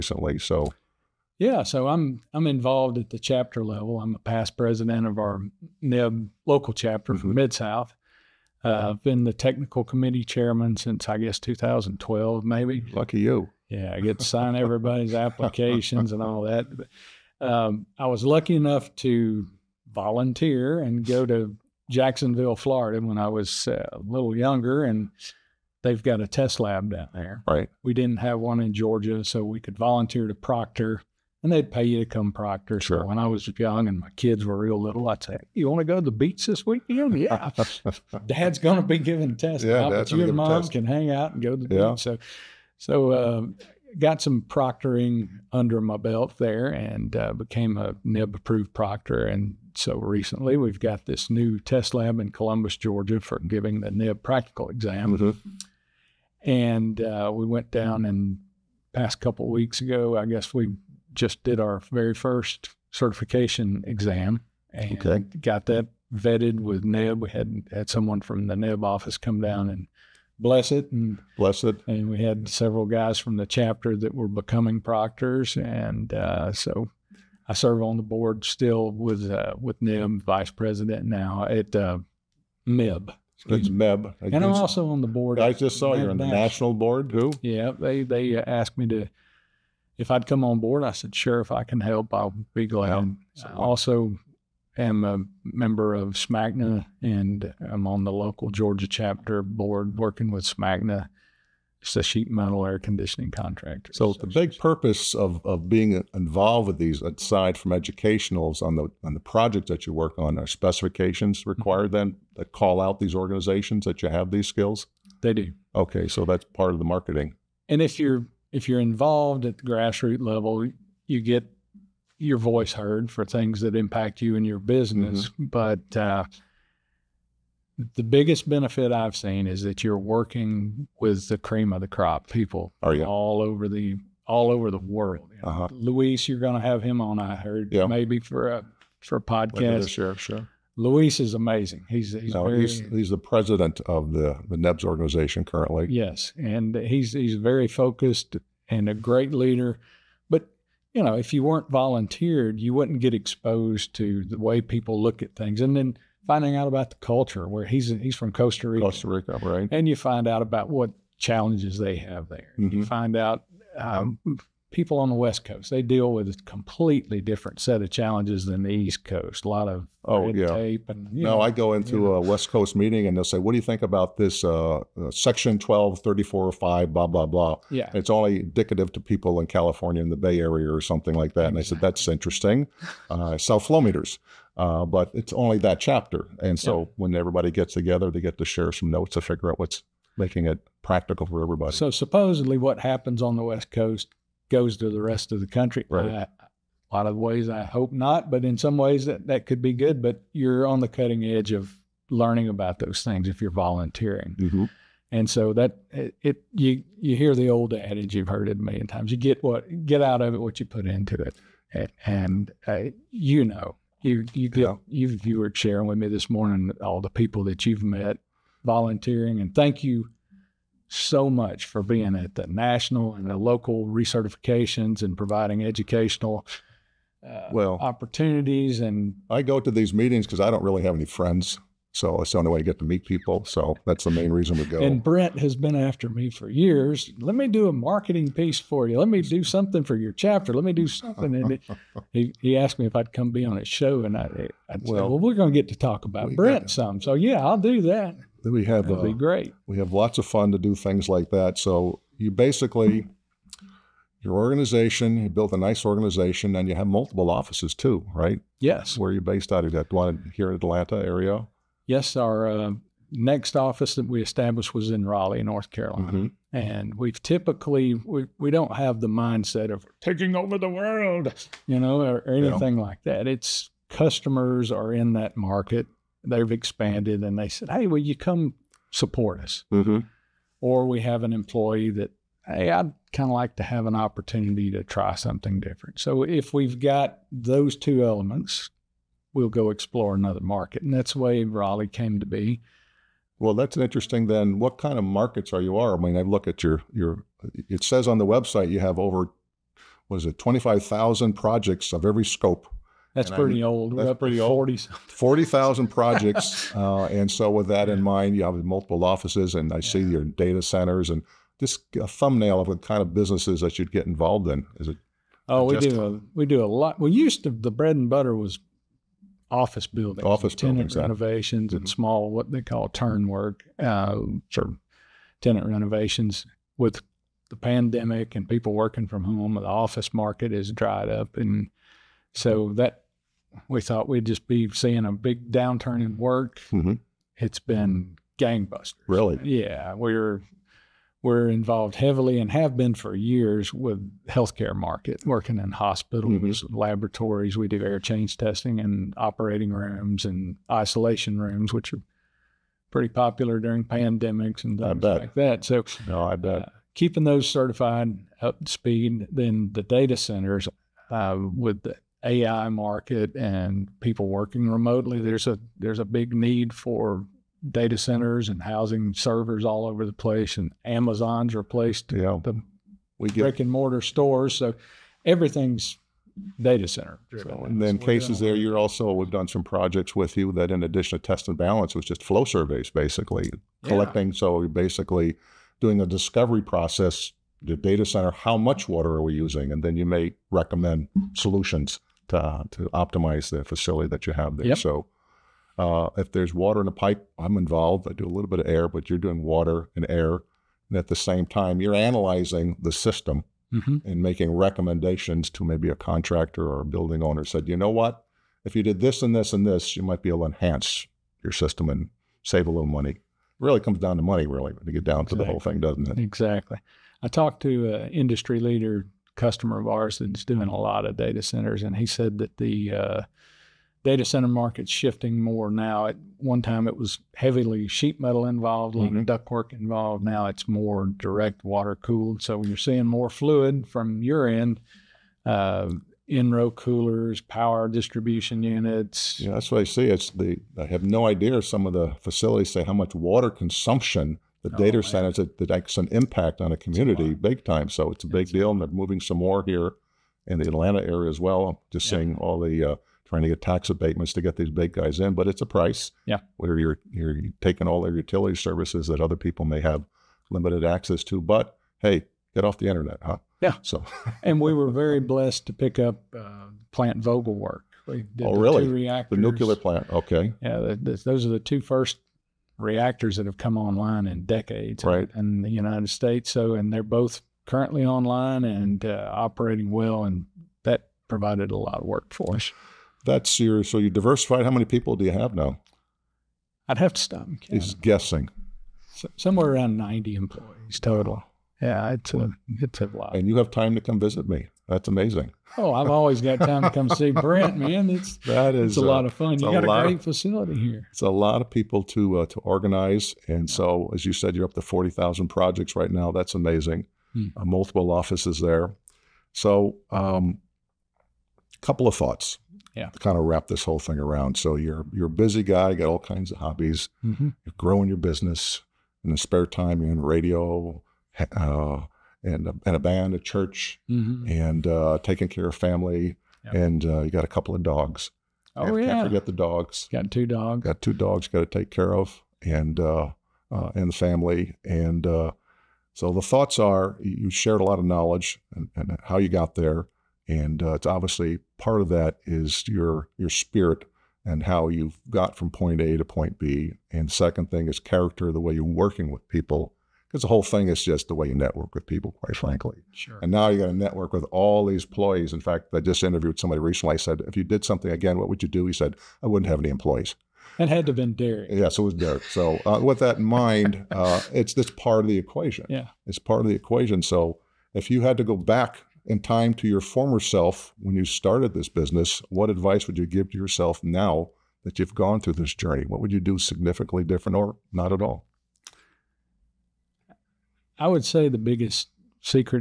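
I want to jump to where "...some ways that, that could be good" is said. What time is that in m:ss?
3:18.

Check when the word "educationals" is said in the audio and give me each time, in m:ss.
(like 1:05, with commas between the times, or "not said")
1:47, 3:45.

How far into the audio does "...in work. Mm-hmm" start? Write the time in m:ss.
5:36.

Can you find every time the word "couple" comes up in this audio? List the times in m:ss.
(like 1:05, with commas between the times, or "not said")
0:59, 8:31, 8:47.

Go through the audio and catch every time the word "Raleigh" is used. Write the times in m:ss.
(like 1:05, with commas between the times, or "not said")
4:25, 4:51.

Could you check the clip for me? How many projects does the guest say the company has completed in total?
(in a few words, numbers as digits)
40,000.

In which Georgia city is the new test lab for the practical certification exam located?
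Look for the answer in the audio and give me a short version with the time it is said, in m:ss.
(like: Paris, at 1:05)
Columbus, at 0:52.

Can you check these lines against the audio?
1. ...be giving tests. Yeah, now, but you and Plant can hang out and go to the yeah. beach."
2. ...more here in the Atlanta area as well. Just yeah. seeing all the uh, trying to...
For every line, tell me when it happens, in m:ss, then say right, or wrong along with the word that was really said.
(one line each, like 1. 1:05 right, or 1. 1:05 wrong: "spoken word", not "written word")
1. 0:38 wrong: "Mom", not "Plant"
2. 7:29 right.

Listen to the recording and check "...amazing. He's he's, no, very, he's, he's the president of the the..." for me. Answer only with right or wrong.
right.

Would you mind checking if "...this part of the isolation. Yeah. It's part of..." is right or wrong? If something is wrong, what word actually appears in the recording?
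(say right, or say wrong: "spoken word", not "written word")
wrong: "equation", not "isolation".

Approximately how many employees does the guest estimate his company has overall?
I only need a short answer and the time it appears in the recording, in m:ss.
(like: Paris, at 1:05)
90, at 8:09.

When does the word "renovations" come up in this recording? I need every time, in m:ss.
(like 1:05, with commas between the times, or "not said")
5:20, 5:25.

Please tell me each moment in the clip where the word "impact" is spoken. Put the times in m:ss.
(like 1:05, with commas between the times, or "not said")
2:03, 7:26.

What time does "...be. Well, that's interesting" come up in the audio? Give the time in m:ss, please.
4:52.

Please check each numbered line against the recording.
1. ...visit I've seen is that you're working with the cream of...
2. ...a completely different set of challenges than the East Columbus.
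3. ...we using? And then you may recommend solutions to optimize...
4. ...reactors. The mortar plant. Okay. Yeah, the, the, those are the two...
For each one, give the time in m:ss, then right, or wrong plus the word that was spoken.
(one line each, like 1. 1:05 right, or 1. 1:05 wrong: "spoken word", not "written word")
1. 2:08 wrong: "benefit", not "visit"
2. 2:46 wrong: "Coast", not "Columbus"
3. 6:29 right
4. 7:48 wrong: "nuclear", not "mortar".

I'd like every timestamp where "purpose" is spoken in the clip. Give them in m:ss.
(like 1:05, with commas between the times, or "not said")
1:44.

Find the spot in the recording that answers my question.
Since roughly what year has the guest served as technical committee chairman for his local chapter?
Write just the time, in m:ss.
0:11.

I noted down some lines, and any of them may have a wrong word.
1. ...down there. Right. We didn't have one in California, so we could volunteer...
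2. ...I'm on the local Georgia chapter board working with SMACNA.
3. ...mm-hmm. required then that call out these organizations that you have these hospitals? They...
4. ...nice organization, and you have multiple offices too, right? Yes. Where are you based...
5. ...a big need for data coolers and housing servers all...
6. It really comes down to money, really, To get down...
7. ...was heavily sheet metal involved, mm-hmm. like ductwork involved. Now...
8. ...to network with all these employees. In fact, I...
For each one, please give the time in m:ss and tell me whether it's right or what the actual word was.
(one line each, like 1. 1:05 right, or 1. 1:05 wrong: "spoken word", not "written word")
1. 0:26 wrong: "Georgia", not "California"
2. 1:37 right
3. 1:51 wrong: "skills", not "hospitals"
4. 4:15 right
5. 6:05 wrong: "centers", not "coolers"
6. 6:53 right
7. 7:06 right
8. 9:13 right.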